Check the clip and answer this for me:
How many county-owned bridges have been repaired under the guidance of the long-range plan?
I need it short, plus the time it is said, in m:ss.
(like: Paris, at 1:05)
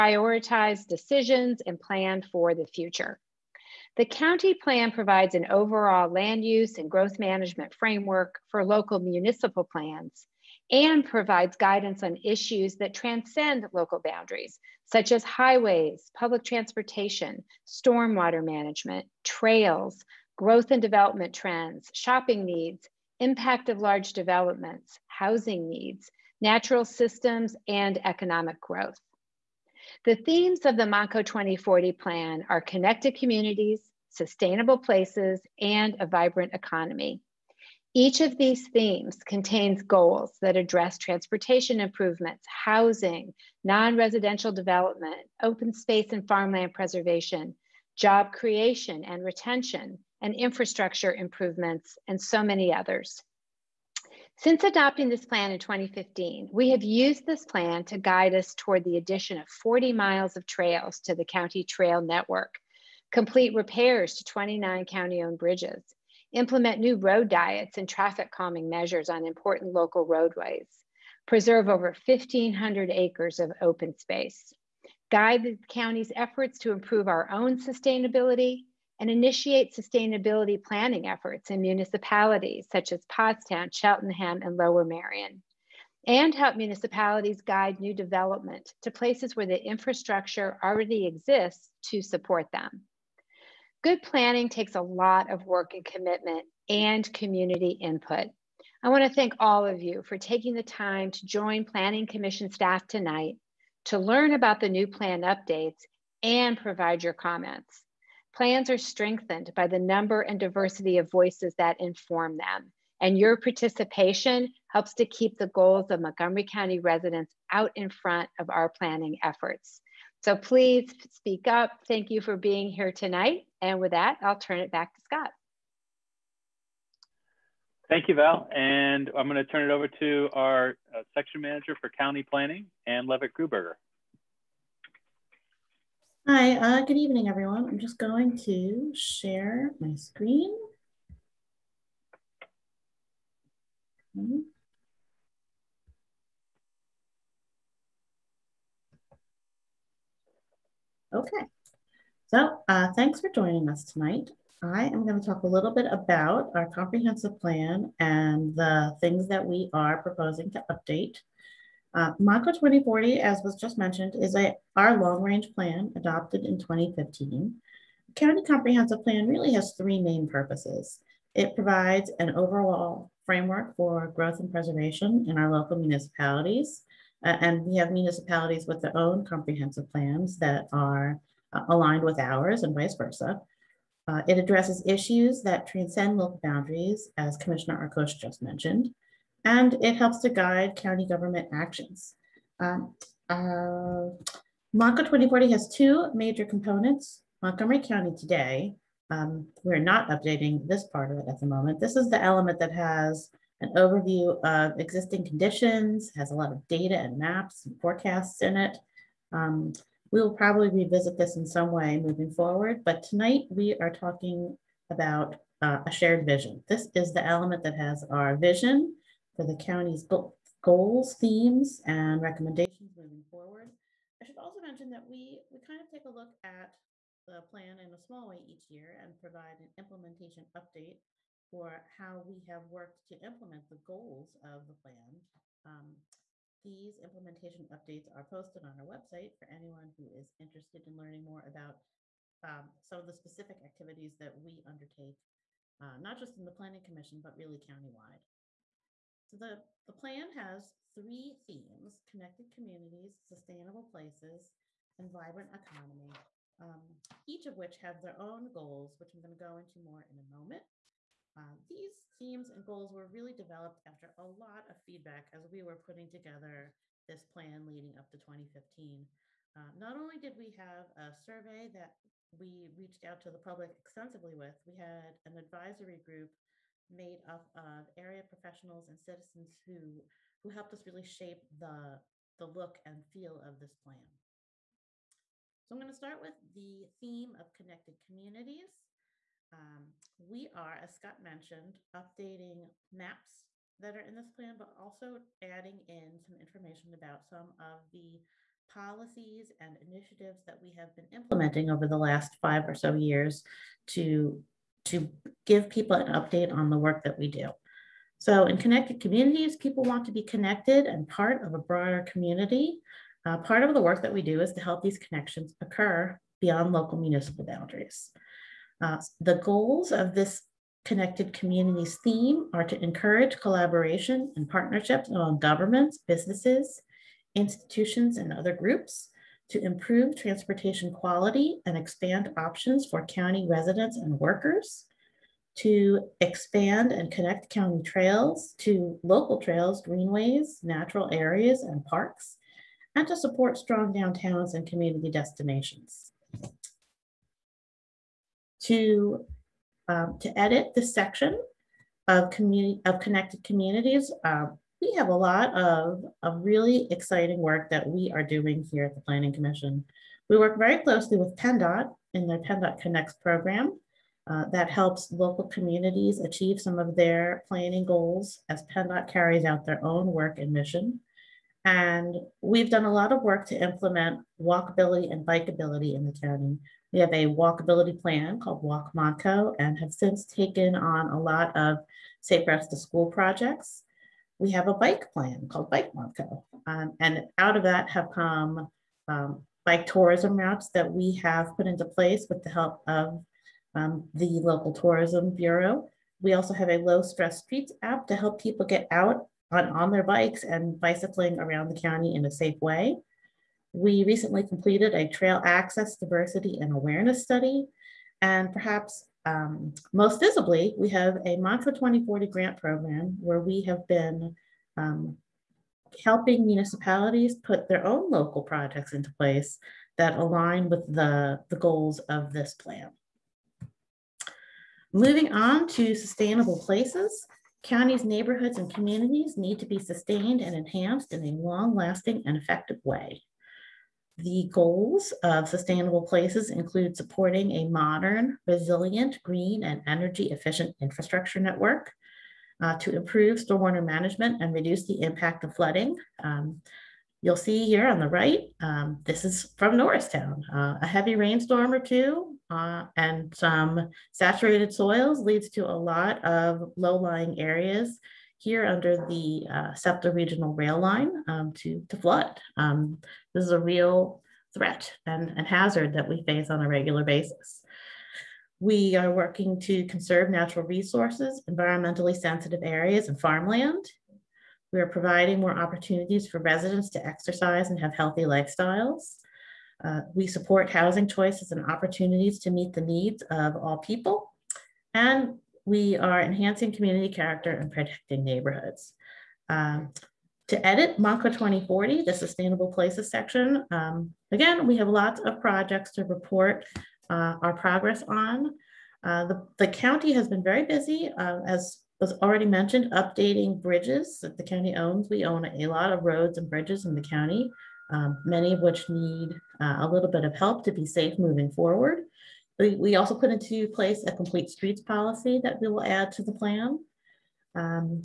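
29, at 1:04.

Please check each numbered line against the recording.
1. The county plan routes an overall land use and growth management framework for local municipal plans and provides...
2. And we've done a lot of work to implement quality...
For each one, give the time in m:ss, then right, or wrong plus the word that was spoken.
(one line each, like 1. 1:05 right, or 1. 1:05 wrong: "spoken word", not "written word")
1. 0:03 wrong: "provides", not "routes"
2. 6:11 wrong: "walkability", not "quality".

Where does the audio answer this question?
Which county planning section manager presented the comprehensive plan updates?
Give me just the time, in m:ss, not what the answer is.
2:12.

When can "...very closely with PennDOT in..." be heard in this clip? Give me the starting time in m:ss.
6:00.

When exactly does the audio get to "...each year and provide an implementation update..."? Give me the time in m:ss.
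3:48.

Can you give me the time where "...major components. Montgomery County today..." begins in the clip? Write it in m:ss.
3:16.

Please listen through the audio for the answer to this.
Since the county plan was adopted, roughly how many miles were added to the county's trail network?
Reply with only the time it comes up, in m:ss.
0:59.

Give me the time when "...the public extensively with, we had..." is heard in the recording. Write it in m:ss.
4:33.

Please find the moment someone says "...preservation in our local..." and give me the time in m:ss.
2:54.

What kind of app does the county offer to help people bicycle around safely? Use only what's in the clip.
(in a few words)
low stress streets app.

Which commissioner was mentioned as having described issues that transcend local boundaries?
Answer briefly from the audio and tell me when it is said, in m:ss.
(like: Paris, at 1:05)
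Arkoosh, at 3:07.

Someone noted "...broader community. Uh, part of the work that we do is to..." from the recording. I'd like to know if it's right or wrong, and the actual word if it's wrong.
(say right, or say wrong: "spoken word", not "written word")
right.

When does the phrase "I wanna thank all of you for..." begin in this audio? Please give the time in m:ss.
1:38.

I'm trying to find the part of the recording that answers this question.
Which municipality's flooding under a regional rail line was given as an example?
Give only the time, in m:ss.
7:29.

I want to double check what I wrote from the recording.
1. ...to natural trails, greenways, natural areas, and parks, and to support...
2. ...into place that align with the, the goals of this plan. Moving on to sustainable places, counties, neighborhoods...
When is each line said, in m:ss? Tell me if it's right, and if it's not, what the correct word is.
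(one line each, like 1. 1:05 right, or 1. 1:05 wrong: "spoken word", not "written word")
1. 5:38 wrong: "local", not "natural"
2. 6:58 right.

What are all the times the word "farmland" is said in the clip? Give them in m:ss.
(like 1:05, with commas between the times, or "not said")
0:46, 7:53.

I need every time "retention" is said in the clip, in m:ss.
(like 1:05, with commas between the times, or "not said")
0:49.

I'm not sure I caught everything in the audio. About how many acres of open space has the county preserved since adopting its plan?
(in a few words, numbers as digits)
1,500.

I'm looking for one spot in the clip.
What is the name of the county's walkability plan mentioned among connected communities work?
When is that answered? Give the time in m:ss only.
6:18.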